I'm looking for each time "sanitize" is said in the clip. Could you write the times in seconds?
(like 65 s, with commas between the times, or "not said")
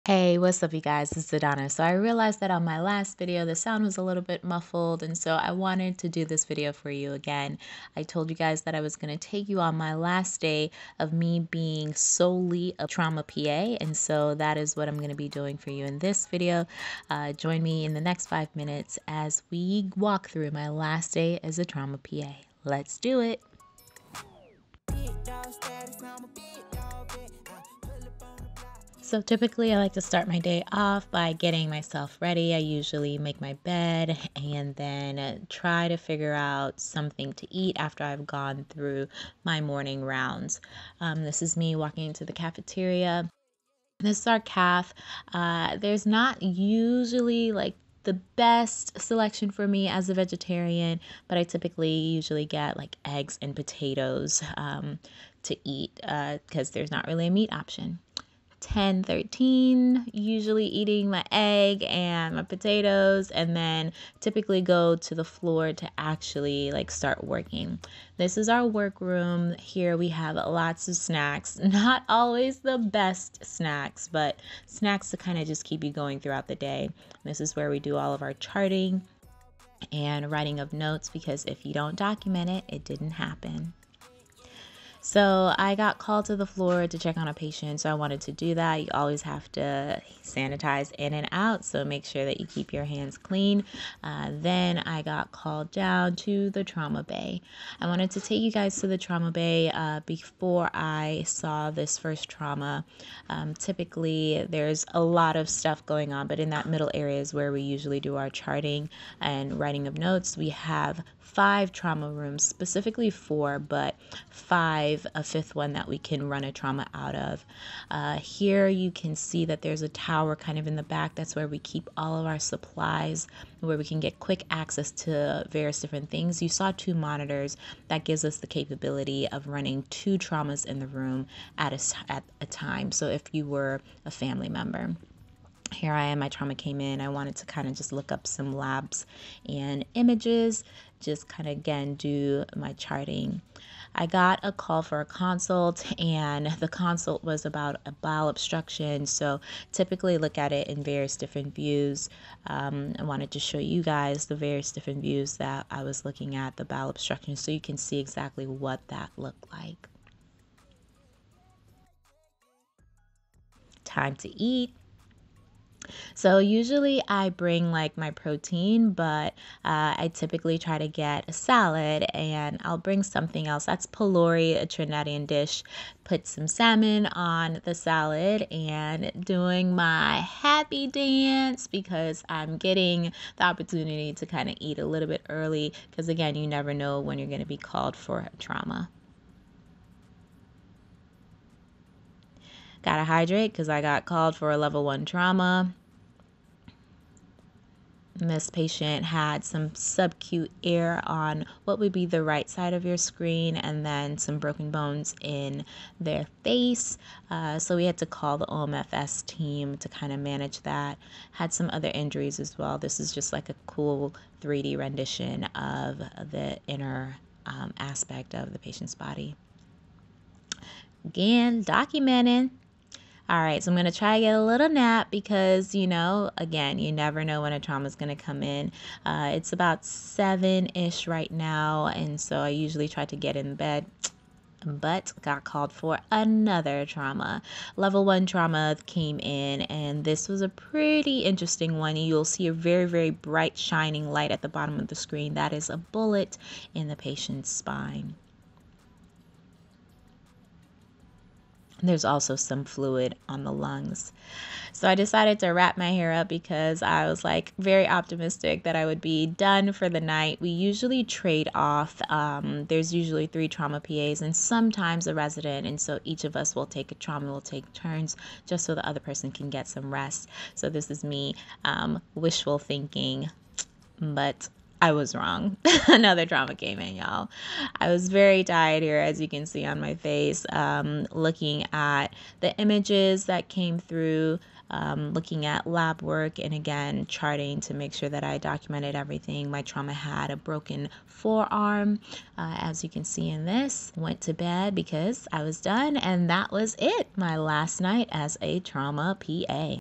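90 s.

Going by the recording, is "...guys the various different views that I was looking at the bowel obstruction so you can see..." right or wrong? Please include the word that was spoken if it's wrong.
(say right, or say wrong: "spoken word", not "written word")
right.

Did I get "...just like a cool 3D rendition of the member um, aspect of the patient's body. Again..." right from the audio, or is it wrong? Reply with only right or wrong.
wrong.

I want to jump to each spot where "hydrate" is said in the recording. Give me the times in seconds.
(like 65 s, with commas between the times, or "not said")
193 s.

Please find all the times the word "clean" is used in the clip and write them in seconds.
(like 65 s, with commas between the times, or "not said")
93 s.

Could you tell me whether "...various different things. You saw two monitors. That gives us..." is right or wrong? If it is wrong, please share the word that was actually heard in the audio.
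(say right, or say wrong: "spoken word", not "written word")
right.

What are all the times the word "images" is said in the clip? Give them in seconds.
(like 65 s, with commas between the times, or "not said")
139 s, 282 s.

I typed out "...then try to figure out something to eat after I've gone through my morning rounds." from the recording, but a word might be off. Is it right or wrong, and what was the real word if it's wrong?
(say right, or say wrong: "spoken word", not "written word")
right.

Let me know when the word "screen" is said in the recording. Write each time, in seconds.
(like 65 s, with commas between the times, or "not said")
202 s, 244 s.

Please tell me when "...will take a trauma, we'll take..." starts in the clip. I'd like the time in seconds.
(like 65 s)
266 s.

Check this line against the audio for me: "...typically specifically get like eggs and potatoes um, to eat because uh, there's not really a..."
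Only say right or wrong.
wrong.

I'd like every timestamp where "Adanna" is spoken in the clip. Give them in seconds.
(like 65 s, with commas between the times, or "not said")
1 s.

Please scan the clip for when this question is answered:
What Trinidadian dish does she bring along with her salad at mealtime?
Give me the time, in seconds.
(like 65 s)
173 s.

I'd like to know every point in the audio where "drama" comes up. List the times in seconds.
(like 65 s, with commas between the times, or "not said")
276 s.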